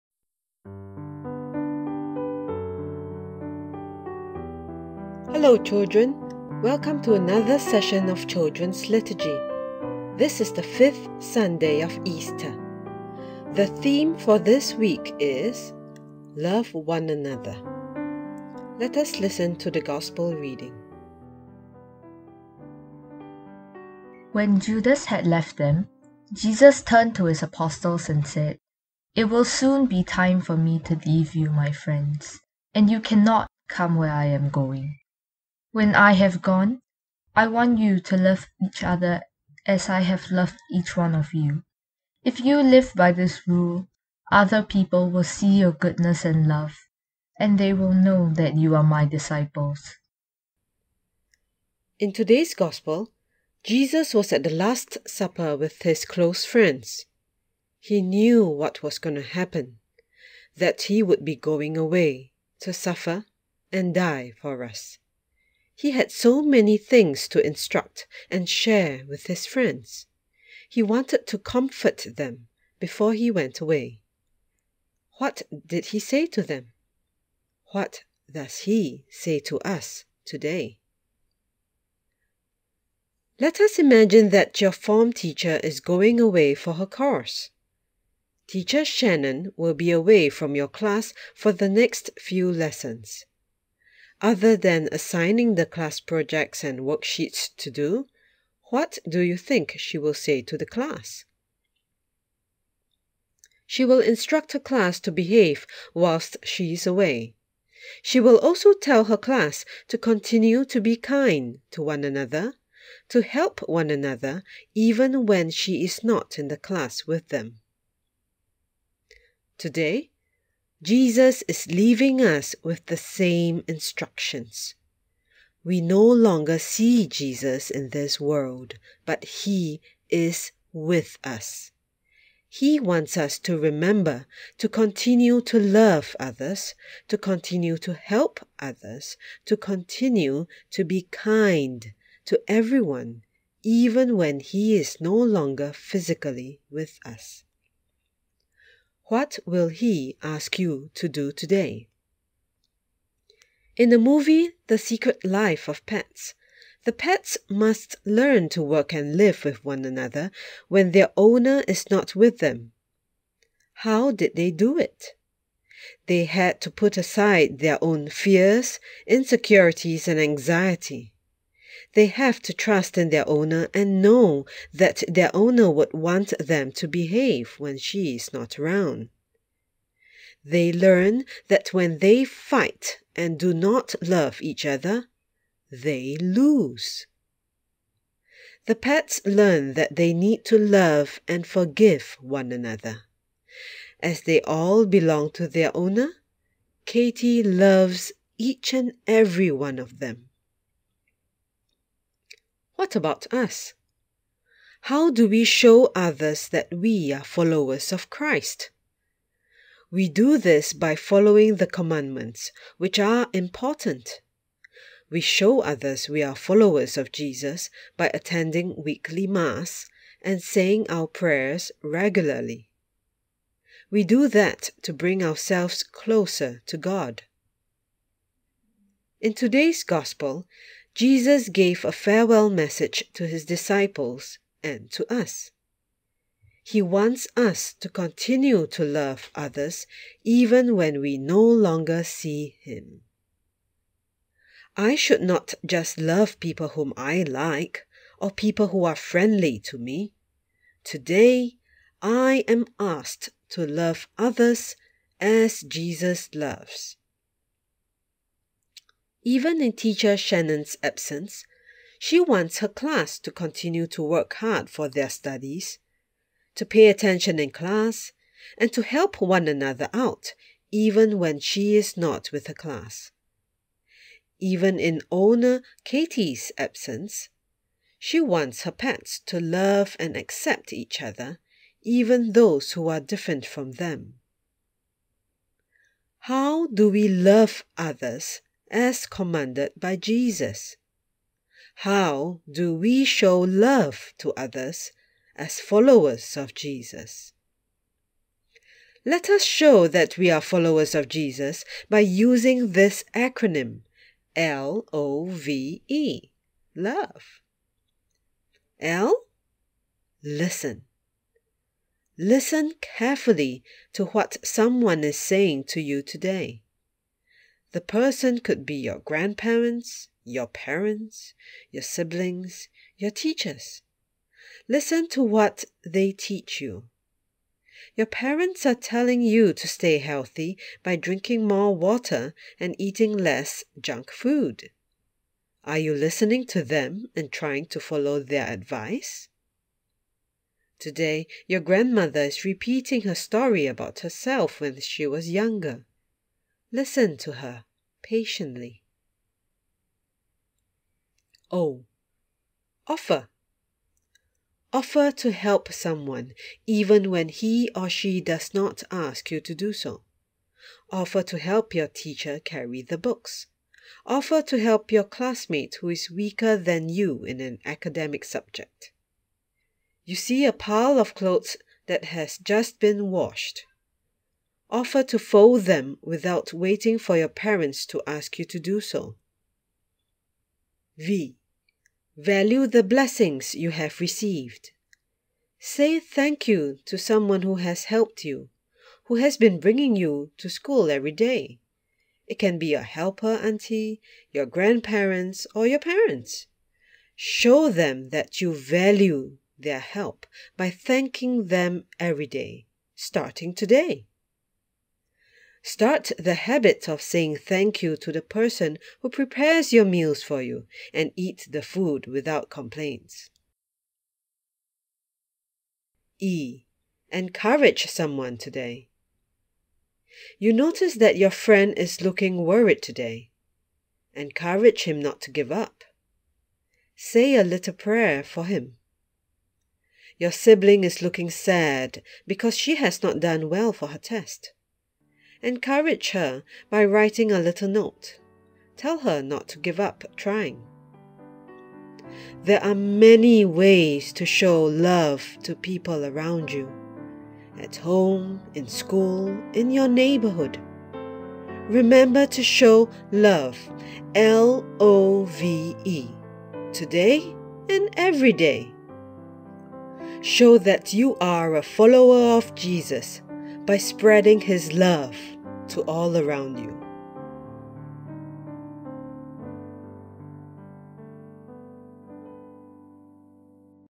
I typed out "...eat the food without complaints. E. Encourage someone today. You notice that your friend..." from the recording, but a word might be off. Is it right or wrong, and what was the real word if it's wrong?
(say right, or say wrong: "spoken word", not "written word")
right.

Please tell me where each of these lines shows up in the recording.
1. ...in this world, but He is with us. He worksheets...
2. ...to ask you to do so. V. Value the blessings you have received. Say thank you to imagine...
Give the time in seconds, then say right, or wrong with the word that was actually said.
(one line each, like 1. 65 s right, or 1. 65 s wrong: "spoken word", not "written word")
1. 127 s wrong: "wants", not "worksheets"
2. 377 s wrong: "someone", not "imagine".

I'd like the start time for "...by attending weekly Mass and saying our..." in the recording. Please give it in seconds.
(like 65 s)
217 s.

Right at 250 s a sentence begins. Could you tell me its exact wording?
Today, I am asked to love others as Jesus loves.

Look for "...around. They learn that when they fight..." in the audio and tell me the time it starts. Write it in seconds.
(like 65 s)
178 s.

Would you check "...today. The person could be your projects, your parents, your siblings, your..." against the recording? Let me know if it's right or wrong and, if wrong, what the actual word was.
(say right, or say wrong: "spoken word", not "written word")
wrong: "grandparents", not "projects".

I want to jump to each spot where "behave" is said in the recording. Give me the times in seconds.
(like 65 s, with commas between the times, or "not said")
105 s, 176 s.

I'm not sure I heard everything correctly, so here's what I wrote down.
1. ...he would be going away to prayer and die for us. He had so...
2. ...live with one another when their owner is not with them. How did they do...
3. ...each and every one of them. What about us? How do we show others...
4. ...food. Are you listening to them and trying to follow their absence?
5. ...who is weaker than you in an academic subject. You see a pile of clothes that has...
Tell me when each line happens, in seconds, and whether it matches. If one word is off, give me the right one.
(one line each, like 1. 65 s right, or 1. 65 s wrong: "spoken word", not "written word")
1. 60 s wrong: "suffer", not "prayer"
2. 159 s right
3. 198 s right
4. 334 s wrong: "advice", not "absence"
5. 365 s right.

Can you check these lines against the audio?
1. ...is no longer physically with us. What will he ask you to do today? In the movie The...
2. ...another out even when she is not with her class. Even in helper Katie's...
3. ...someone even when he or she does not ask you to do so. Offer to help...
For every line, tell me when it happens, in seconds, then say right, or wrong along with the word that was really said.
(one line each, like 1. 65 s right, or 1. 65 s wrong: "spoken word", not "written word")
1. 144 s right
2. 269 s wrong: "owner", not "helper"
3. 355 s right.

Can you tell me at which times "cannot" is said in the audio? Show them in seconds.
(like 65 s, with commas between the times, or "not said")
32 s.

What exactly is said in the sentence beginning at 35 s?
When I have gone, I want you to love each other as I have loved each one of you.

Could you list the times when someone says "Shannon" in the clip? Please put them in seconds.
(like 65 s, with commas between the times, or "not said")
88 s, 260 s.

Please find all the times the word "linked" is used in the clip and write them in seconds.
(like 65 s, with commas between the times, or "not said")
not said.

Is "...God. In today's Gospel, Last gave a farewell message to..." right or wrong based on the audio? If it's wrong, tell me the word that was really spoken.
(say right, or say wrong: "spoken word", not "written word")
wrong: "Jesus", not "Last".